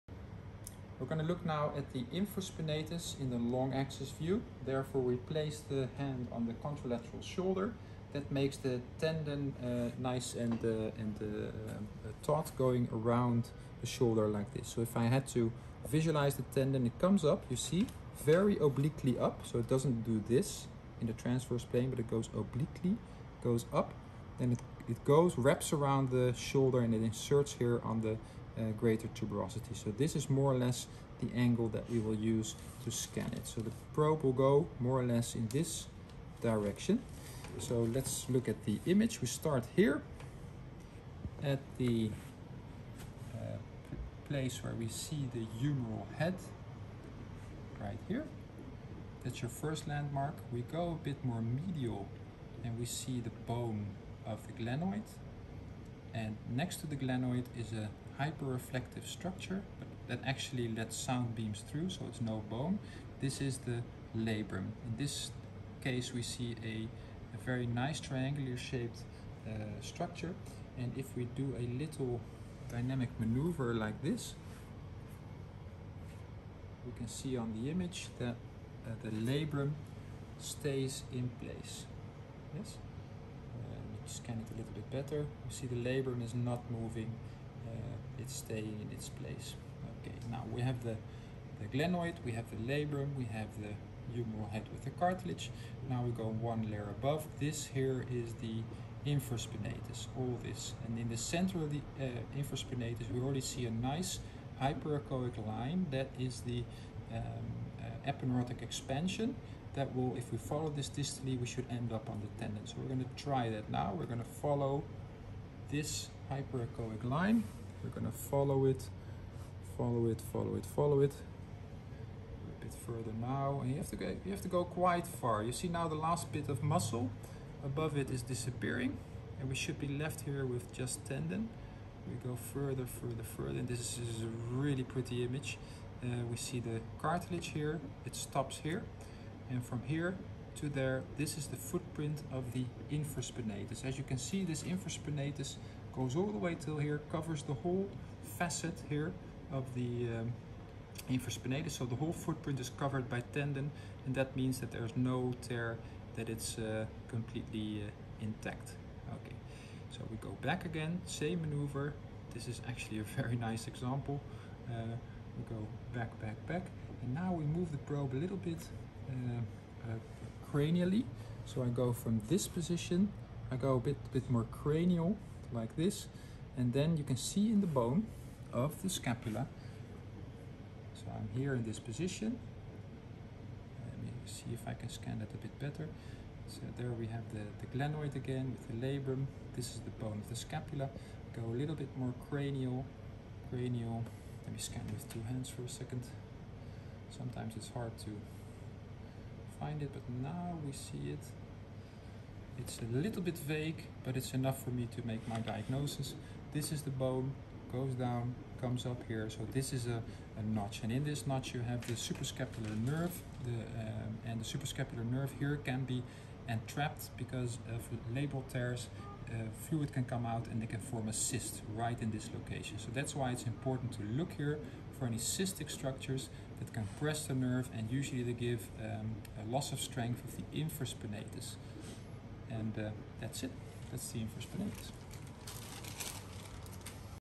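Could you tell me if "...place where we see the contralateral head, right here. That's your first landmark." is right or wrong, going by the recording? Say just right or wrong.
wrong.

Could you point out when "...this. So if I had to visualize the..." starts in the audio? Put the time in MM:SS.
00:14.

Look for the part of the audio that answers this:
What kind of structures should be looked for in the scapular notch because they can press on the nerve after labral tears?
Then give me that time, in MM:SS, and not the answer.
03:45.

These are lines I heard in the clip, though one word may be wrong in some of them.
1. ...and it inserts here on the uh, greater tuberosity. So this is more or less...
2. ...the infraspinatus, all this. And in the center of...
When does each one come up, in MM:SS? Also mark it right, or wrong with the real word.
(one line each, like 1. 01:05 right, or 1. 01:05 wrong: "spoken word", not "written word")
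1. 00:26 right
2. 01:38 right.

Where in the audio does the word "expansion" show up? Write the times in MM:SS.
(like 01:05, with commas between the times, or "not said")
01:48.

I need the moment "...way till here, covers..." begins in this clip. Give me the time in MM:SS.
02:26.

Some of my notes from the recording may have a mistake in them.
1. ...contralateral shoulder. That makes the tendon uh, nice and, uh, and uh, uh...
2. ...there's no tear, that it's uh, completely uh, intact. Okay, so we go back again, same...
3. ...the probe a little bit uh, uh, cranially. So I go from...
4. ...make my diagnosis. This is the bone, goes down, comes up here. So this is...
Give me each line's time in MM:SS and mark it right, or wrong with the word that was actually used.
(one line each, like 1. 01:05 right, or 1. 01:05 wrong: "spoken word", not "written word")
1. 00:06 right
2. 02:34 right
3. 02:47 right
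4. 03:25 right.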